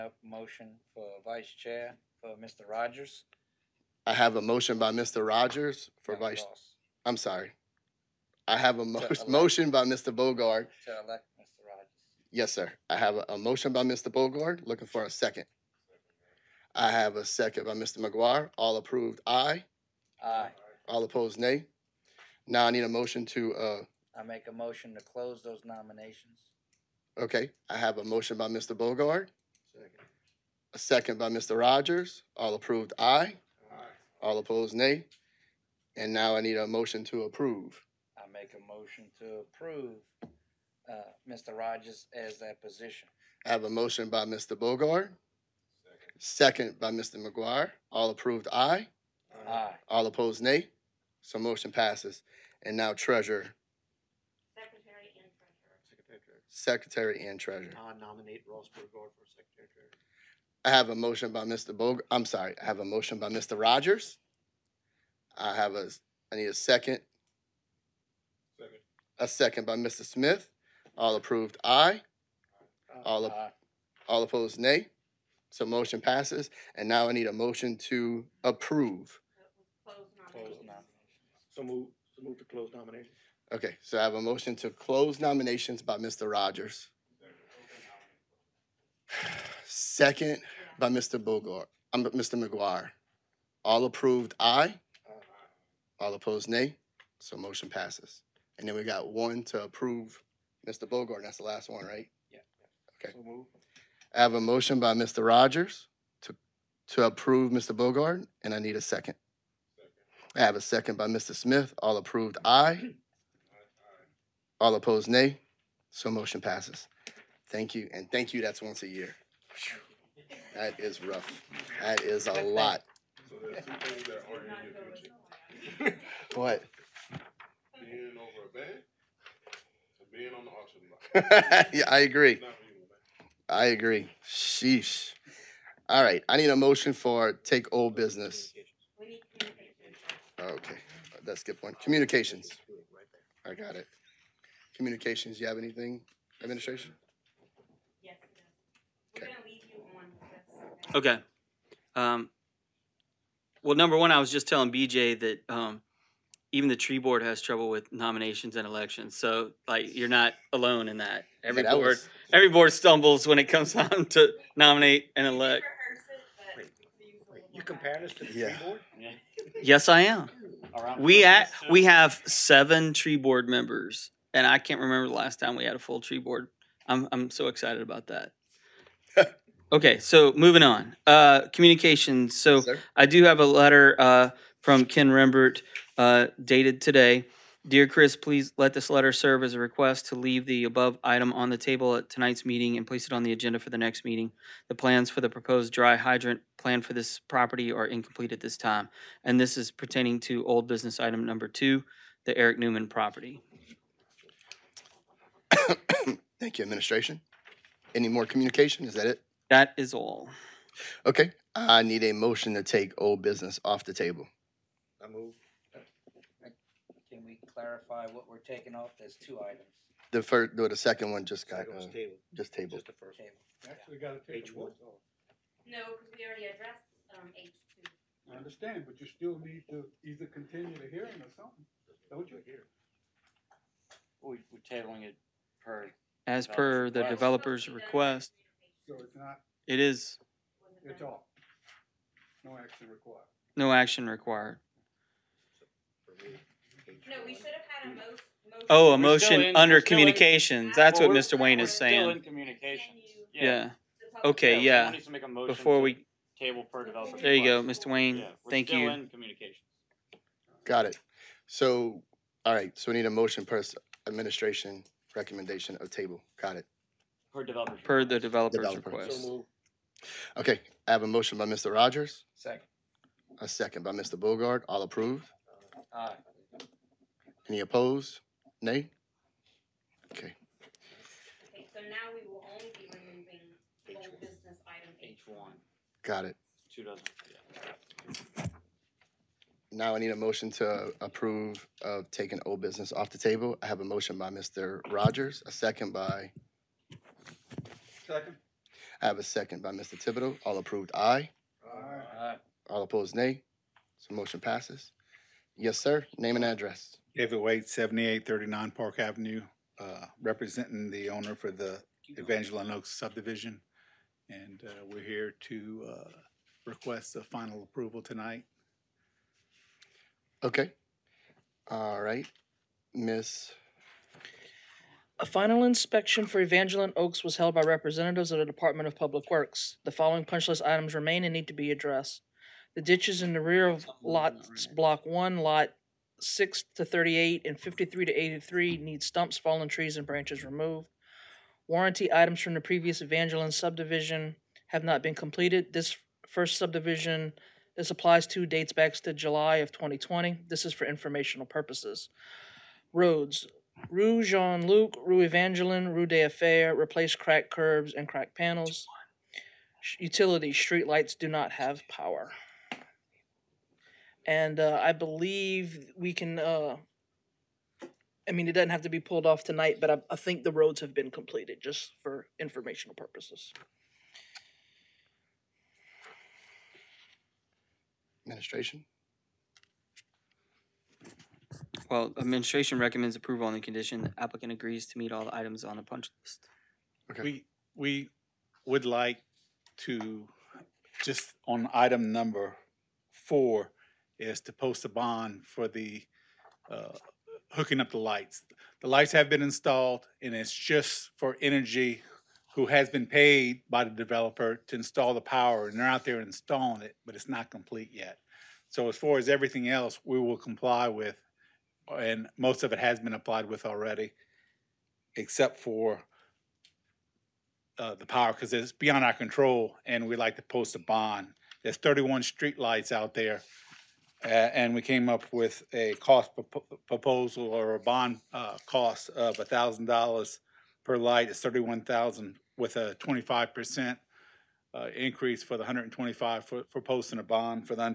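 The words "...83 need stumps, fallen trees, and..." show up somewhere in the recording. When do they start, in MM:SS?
05:38.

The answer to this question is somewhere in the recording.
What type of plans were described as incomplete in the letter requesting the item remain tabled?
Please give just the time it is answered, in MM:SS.
03:15.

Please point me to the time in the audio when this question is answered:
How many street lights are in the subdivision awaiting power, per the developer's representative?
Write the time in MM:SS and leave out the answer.
07:01.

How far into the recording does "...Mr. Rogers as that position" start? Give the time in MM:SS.
00:41.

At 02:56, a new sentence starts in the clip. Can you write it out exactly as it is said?
I'm I'm so excited about that.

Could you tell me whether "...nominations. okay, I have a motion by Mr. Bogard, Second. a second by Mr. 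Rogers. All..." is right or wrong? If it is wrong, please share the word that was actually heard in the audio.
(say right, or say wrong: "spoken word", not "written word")
right.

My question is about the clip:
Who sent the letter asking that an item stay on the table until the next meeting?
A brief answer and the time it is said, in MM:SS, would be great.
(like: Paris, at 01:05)
Ken Rembert, at 03:04.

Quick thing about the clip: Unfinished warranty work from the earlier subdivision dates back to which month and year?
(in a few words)
July 2020.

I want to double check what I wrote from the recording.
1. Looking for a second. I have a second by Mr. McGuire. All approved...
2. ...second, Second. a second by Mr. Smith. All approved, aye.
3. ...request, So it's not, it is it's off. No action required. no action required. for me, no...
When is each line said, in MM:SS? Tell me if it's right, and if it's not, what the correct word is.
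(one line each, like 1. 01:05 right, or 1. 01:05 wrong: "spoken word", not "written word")
1. 00:14 right
2. 01:06 right
3. 03:57 right.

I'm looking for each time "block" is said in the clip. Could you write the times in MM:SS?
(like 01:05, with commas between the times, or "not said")
02:11, 05:34.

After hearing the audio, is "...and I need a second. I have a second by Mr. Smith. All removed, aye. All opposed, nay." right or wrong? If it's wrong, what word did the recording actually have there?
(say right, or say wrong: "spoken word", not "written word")
wrong: "approved", not "removed".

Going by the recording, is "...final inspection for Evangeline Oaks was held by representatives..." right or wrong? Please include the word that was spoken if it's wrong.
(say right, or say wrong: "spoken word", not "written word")
right.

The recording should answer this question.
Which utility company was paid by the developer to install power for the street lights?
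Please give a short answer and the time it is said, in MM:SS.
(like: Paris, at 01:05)
Entergy, at 06:41.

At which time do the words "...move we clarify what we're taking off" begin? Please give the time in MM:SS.
03:35.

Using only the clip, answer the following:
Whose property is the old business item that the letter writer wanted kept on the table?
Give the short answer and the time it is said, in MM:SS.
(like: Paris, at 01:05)
Eric Newman, at 03:22.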